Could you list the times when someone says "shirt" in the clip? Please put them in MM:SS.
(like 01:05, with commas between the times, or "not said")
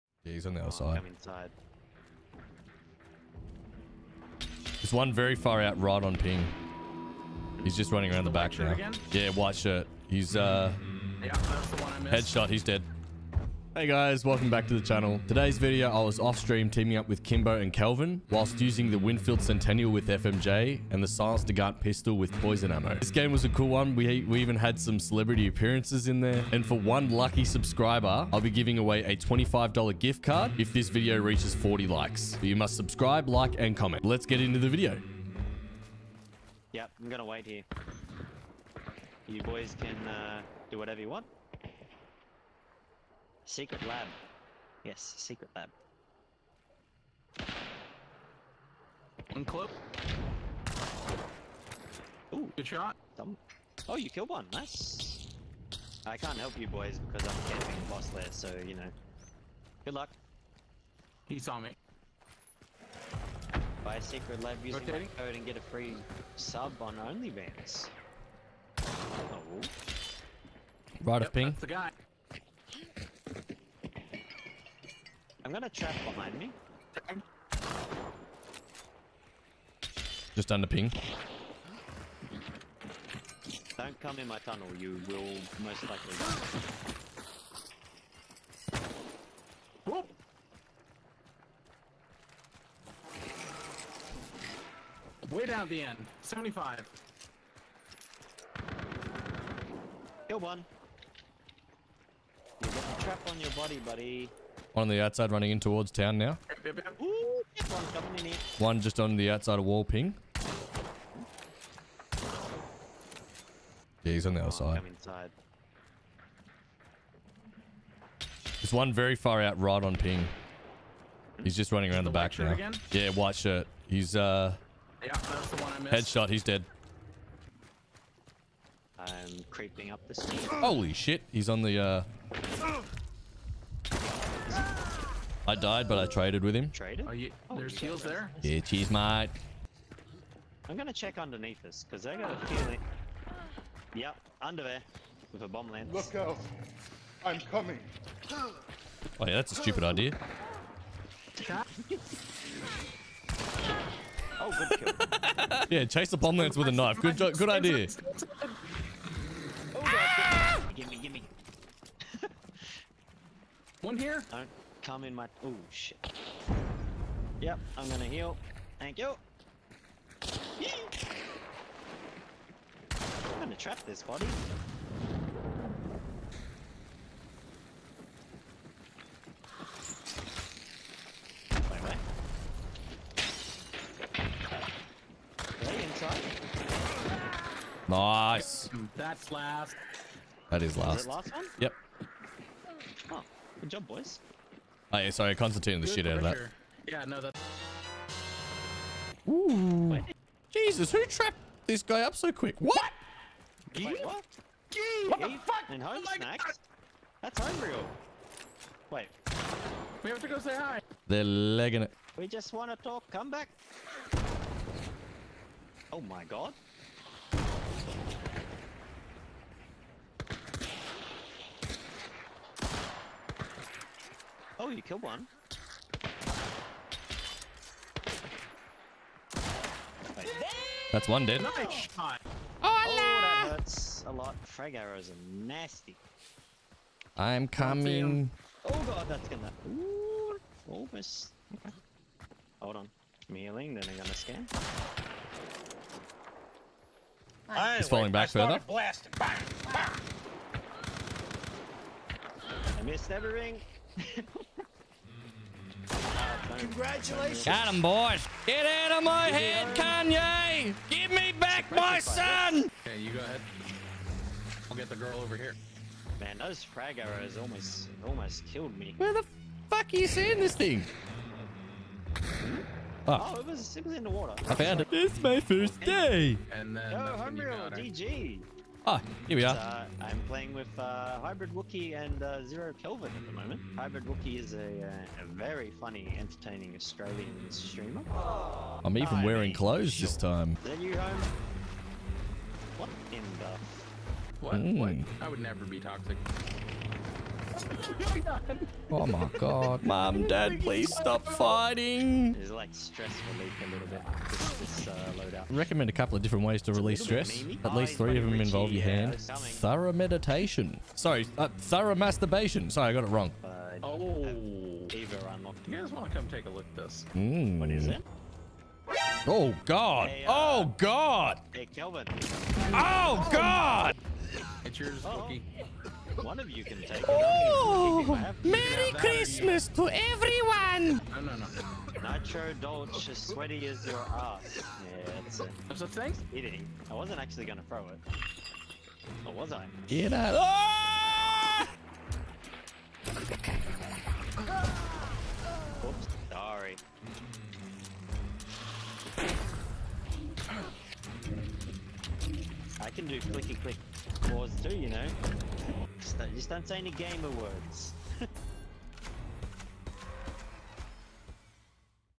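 00:09, 02:03.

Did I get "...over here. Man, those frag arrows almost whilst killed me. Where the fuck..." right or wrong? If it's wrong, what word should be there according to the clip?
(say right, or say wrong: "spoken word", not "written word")
wrong: "almost", not "whilst".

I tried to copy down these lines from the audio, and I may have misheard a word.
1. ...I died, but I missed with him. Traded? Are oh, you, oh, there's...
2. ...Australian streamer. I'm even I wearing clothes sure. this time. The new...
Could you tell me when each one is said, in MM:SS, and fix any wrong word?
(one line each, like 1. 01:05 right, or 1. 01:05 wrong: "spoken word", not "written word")
1. 02:15 wrong: "traded", not "missed"
2. 04:46 right.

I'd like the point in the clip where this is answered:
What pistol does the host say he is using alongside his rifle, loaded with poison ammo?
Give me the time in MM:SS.
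00:21.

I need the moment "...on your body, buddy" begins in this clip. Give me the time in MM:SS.
01:43.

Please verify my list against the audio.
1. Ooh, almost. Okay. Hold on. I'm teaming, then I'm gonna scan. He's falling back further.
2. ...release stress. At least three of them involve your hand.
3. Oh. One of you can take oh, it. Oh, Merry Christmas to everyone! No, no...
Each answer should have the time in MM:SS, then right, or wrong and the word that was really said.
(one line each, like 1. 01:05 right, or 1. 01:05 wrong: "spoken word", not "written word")
1. 03:59 wrong: "healing", not "teaming"
2. 05:06 right
3. 05:25 right.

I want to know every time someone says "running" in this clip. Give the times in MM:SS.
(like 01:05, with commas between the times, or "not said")
00:07, 01:45, 02:01.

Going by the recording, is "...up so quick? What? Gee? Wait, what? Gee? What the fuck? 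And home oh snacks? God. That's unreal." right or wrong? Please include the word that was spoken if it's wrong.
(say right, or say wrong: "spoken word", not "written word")
right.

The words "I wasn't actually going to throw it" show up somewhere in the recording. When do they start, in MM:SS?
05:36.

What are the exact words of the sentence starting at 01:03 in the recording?
Buy a Secretlab using my code and get a free sub on OnlyFans.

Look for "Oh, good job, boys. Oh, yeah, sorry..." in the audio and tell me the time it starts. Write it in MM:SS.
03:13.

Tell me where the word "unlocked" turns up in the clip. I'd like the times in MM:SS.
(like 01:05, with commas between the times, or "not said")
05:15.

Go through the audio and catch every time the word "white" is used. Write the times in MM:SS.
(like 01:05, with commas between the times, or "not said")
00:09, 02:03.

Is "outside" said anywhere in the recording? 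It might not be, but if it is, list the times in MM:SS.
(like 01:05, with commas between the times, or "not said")
01:45, 01:49.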